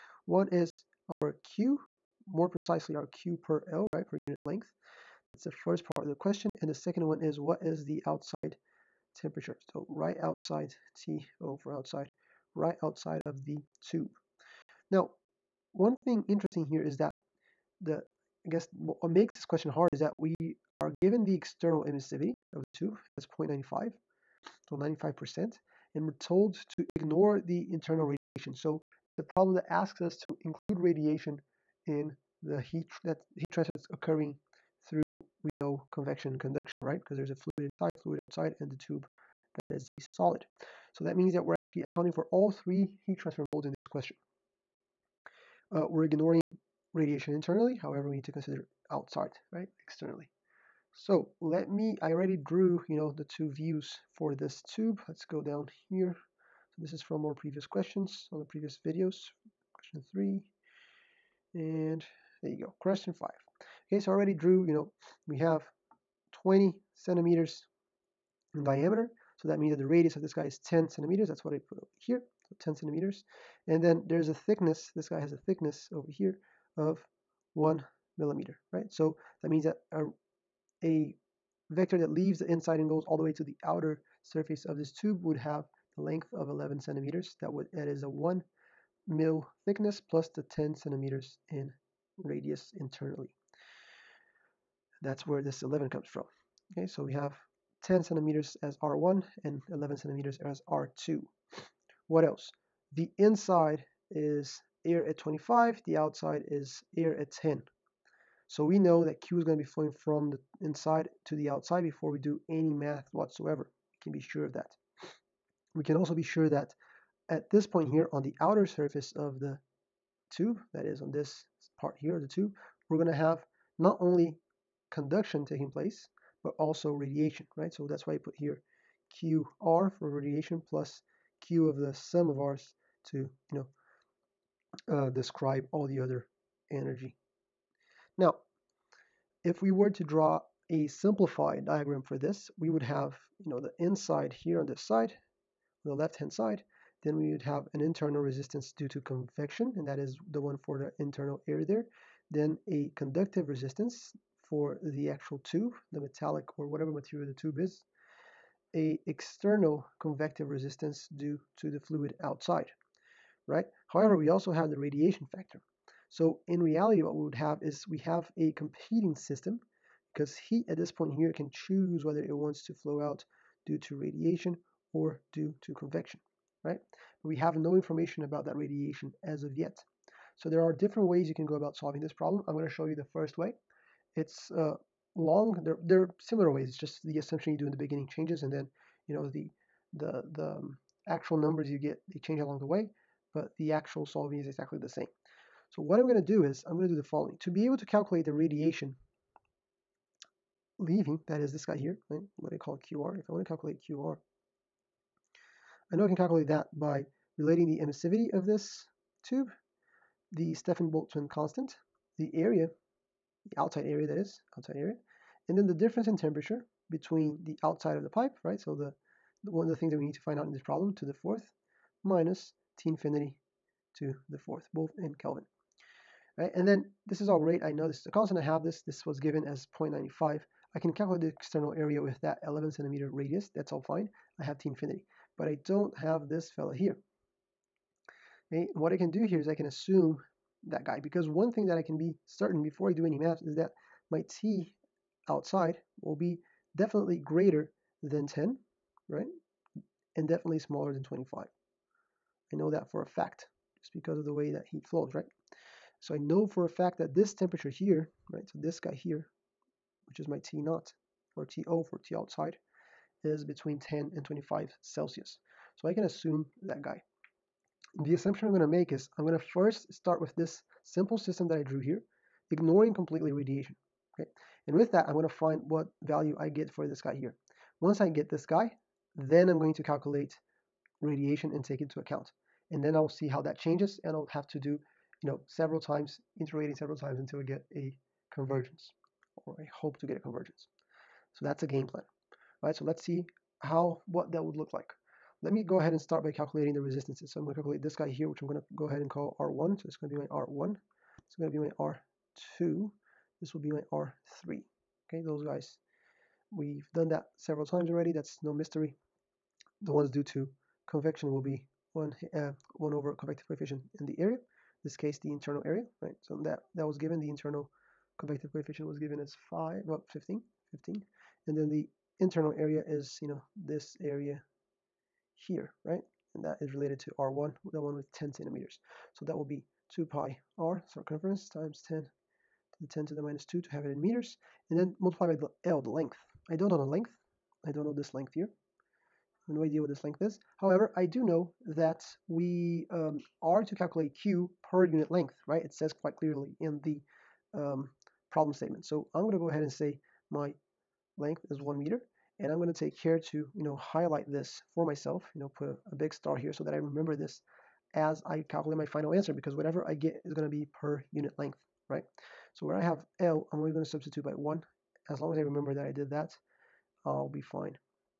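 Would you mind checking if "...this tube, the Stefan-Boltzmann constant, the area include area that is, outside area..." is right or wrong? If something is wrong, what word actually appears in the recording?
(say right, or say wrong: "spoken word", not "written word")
wrong: "outside", not "include".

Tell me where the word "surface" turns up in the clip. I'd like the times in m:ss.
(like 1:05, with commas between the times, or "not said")
1:24, 1:58.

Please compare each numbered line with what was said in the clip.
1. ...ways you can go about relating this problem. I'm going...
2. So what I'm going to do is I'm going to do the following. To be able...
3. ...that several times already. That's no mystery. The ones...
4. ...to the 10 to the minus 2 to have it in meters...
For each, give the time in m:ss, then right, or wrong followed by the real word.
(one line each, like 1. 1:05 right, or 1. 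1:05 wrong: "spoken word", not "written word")
1. 3:01 wrong: "solving", not "relating"
2. 3:15 right
3. 5:07 right
4. 5:32 right.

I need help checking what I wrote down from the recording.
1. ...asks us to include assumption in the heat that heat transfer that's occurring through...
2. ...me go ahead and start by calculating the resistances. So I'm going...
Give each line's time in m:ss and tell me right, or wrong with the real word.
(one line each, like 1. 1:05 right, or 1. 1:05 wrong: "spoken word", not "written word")
1. 0:29 wrong: "radiation", not "assumption"
2. 4:55 right.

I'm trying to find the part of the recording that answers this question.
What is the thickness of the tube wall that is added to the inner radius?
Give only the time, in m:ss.
1:17.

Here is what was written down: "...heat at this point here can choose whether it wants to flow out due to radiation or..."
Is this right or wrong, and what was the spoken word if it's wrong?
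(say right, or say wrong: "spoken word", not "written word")
right.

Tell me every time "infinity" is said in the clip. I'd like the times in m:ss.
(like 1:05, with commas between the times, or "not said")
3:42, 3:54.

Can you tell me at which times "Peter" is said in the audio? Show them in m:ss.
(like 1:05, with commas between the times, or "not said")
not said.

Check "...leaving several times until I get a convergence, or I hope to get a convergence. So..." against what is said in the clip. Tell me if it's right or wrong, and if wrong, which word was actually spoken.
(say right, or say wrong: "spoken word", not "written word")
wrong: "iterating", not "leaving".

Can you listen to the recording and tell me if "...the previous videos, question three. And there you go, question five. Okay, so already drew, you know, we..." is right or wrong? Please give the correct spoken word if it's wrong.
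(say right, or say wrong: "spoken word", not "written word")
right.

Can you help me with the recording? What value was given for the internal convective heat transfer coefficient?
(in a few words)
15.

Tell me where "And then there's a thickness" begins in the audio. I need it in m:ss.
1:13.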